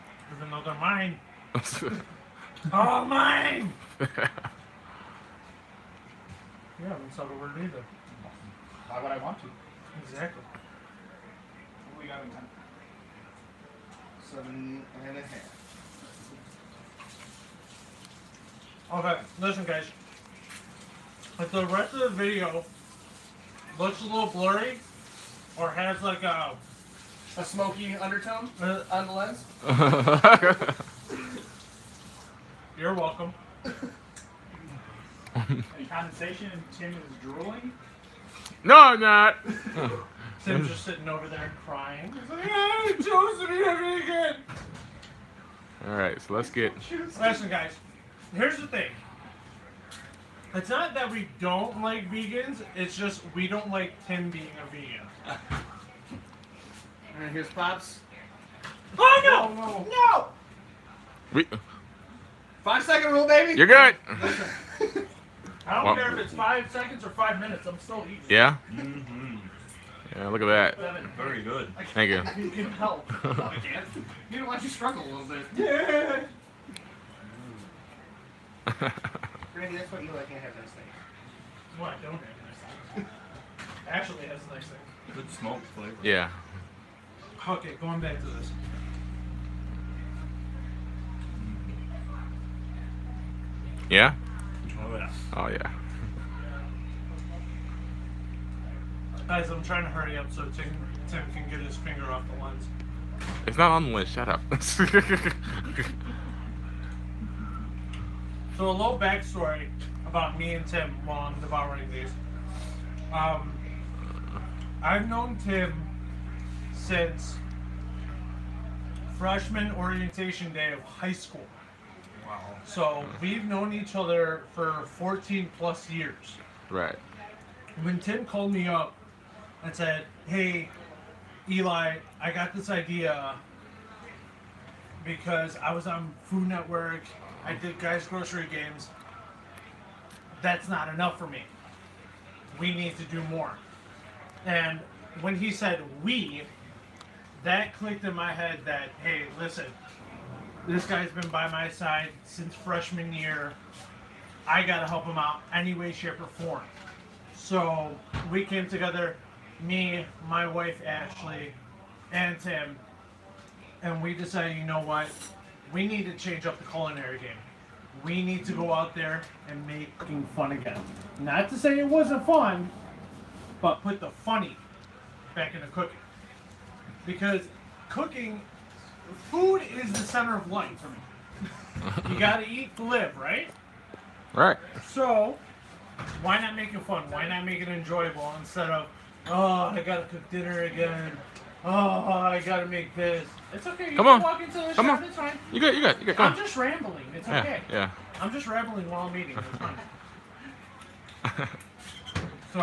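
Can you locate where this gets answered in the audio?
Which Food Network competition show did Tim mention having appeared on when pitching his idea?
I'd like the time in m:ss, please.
2:17.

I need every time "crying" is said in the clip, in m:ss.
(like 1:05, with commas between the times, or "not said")
0:41.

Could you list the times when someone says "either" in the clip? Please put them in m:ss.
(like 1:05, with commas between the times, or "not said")
0:07.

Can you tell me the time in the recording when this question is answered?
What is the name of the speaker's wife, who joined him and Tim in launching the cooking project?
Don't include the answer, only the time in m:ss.
2:40.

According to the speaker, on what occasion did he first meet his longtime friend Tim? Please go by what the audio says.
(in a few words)
Freshman orientation day.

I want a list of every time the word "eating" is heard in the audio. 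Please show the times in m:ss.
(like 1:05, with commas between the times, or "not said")
1:08, 3:19.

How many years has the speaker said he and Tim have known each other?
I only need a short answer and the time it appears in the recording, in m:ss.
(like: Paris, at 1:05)
14 plus years, at 2:04.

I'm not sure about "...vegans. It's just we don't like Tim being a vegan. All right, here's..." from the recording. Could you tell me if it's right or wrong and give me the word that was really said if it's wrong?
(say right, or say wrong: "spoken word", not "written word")
right.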